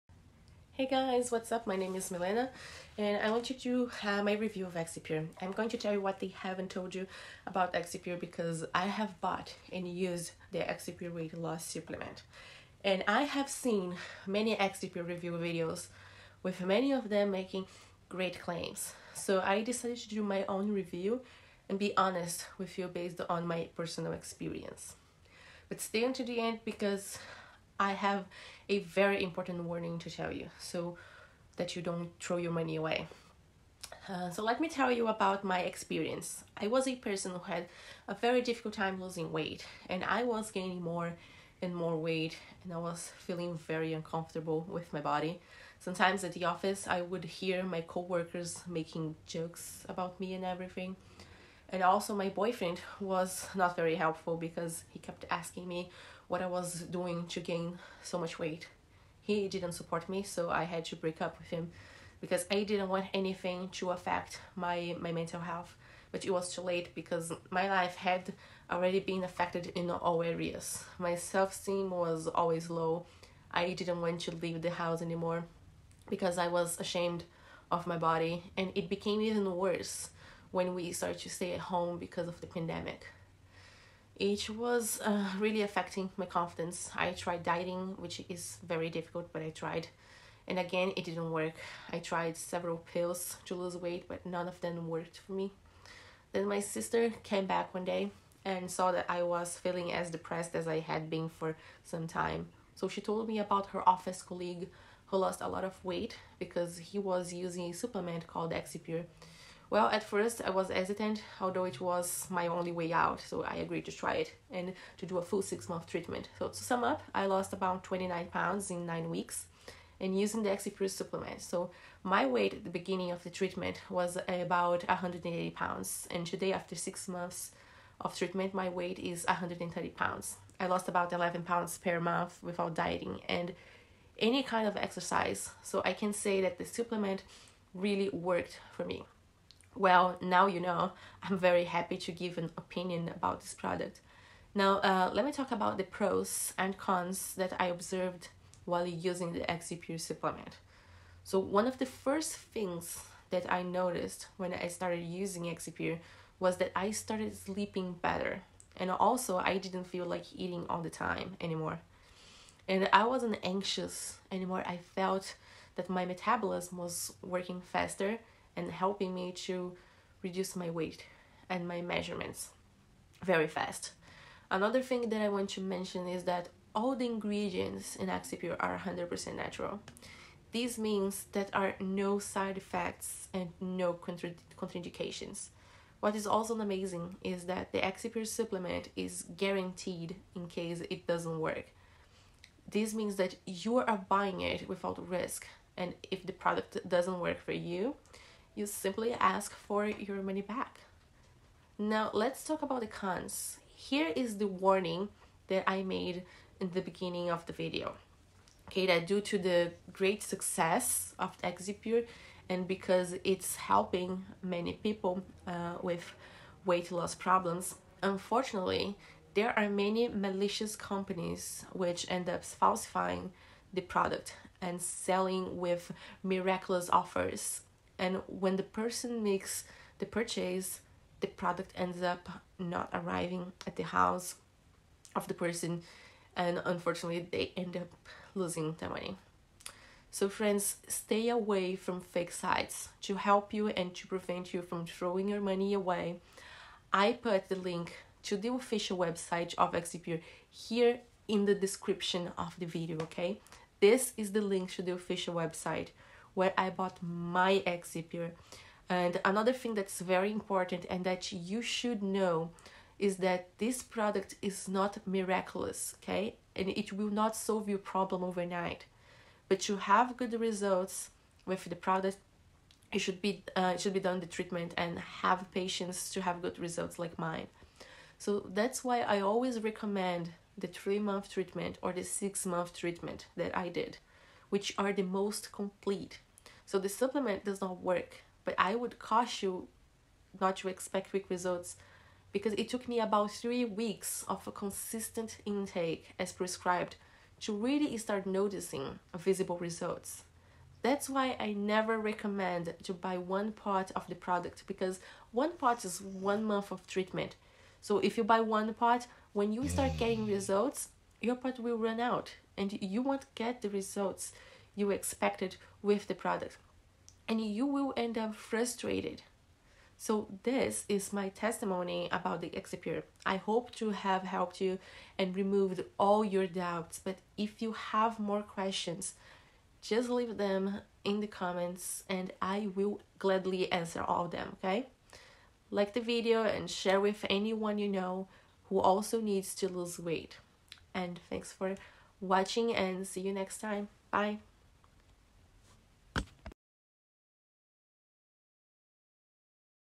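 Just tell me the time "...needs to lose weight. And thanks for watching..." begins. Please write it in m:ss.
5:39.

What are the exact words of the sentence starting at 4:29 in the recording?
But you have good results with the product.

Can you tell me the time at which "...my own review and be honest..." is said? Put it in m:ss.
0:20.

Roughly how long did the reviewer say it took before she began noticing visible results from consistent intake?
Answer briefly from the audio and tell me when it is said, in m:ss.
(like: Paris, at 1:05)
3 weeks, at 4:53.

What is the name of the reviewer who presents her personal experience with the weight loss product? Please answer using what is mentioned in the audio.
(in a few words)
Milena.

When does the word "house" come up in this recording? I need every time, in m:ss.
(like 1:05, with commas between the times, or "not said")
1:14, 3:53.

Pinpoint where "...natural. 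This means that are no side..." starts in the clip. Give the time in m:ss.
2:59.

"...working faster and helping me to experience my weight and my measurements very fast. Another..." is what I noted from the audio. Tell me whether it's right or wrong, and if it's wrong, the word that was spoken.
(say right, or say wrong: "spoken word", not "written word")
wrong: "reduce", not "experience".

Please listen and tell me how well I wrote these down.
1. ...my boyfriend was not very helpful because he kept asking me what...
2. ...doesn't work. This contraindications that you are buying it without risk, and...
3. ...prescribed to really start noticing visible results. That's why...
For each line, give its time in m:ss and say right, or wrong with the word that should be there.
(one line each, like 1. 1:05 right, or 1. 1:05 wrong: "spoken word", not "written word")
1. 0:52 right
2. 3:11 wrong: "means", not "contraindications"
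3. 4:56 right.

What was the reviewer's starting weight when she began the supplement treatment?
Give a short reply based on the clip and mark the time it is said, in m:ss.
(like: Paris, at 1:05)
180 pounds, at 2:04.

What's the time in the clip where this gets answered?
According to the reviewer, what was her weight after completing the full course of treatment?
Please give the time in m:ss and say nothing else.
2:09.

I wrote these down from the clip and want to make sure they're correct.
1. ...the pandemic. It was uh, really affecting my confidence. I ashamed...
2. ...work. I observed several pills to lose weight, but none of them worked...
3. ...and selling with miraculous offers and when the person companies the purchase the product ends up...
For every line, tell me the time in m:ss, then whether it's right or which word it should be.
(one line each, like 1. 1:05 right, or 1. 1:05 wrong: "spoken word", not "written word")
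1. 1:22 wrong: "tried", not "ashamed"
2. 1:31 wrong: "tried", not "observed"
3. 3:44 wrong: "makes", not "companies".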